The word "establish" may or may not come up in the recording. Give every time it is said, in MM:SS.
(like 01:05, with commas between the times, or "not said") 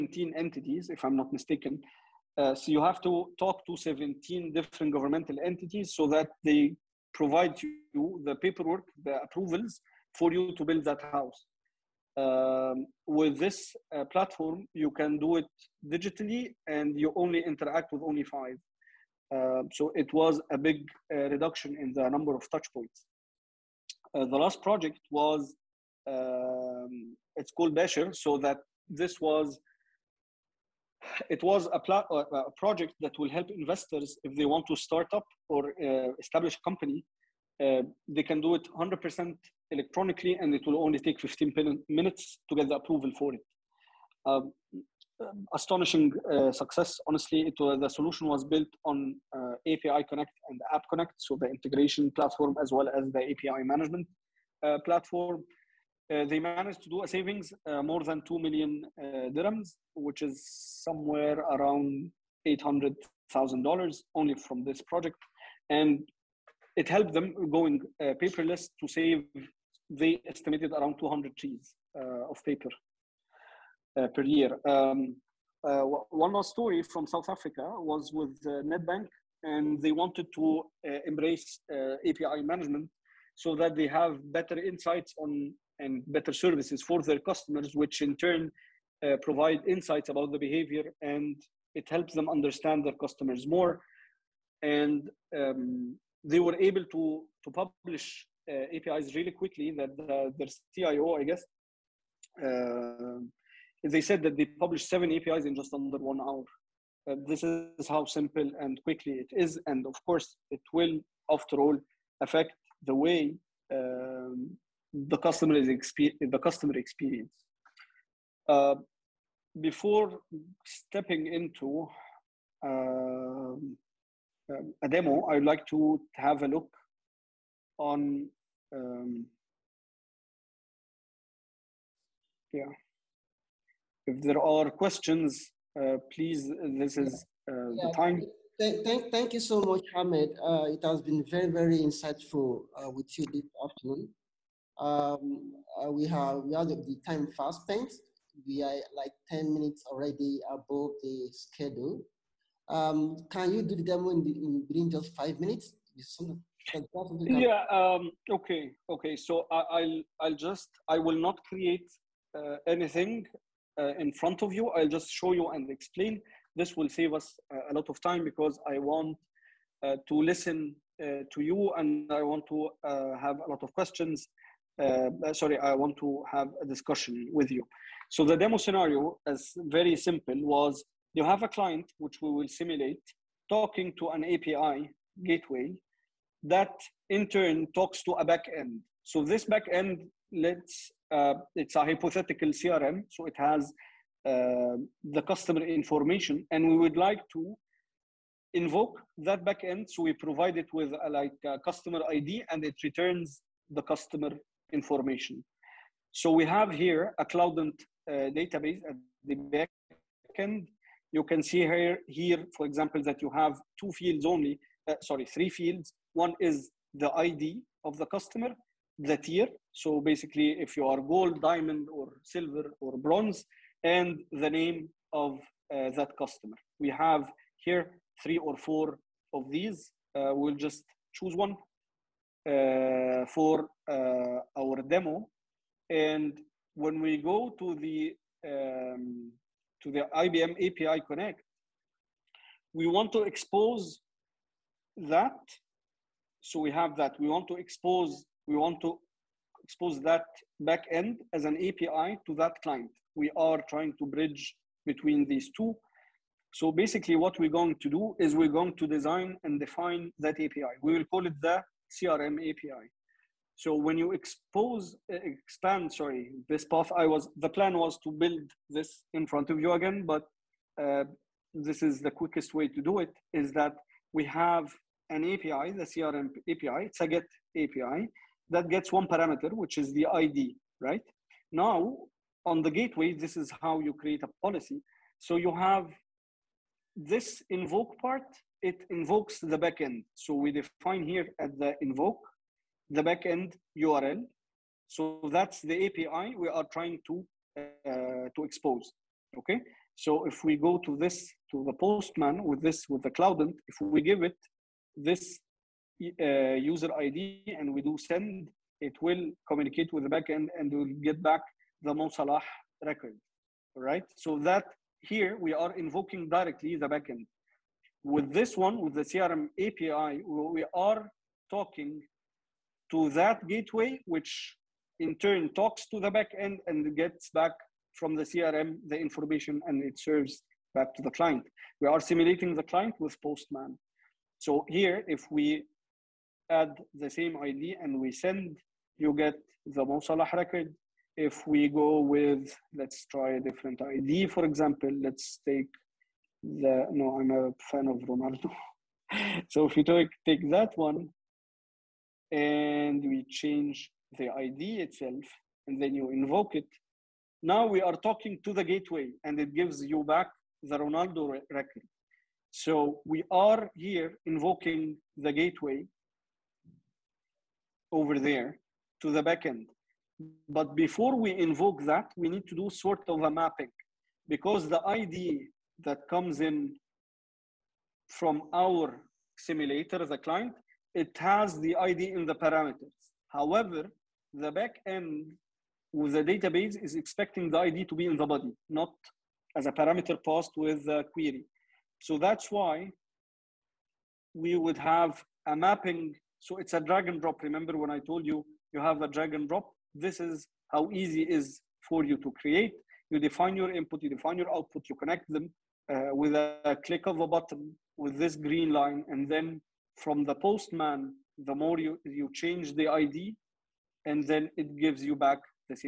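00:36.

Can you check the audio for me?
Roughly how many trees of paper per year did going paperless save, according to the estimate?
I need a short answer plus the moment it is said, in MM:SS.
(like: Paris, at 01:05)
200, at 01:10.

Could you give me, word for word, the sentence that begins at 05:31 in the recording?
We are simulating the client with Postman.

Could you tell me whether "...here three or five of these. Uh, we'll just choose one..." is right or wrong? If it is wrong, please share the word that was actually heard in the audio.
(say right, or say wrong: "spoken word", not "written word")
wrong: "four", not "five".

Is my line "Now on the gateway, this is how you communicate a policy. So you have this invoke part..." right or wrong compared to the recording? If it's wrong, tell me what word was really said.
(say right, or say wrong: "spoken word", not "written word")
wrong: "create", not "communicate".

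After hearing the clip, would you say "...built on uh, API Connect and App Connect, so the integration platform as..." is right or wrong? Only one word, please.
right.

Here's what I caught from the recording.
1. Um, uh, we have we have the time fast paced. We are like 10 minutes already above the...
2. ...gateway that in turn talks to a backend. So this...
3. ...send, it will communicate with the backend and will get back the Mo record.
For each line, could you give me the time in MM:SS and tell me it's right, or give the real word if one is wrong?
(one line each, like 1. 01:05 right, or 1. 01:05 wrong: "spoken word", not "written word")
1. 02:24 right
2. 03:05 right
3. 05:07 right.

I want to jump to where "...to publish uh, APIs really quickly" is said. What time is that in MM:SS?
01:37.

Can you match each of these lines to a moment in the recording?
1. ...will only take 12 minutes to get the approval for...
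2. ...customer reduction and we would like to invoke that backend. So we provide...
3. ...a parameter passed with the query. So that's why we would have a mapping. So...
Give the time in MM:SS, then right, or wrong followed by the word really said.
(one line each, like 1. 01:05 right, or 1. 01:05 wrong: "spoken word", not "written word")
1. 00:40 wrong: "15", not "12"
2. 03:15 wrong: "information", not "reduction"
3. 06:29 right.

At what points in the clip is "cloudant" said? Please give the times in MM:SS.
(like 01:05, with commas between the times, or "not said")
03:27, 05:03.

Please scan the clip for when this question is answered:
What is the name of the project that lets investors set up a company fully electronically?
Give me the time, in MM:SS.
00:27.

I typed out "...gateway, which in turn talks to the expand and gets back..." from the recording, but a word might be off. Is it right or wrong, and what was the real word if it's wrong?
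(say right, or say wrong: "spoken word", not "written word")
wrong: "backend", not "expand".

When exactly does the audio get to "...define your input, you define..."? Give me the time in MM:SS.
06:43.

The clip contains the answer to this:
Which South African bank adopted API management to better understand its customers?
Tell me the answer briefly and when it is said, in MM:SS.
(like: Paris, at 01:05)
Nedbank, at 01:18.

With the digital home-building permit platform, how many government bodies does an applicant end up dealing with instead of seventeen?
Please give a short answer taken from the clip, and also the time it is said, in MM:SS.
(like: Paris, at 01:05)
5, at 00:18.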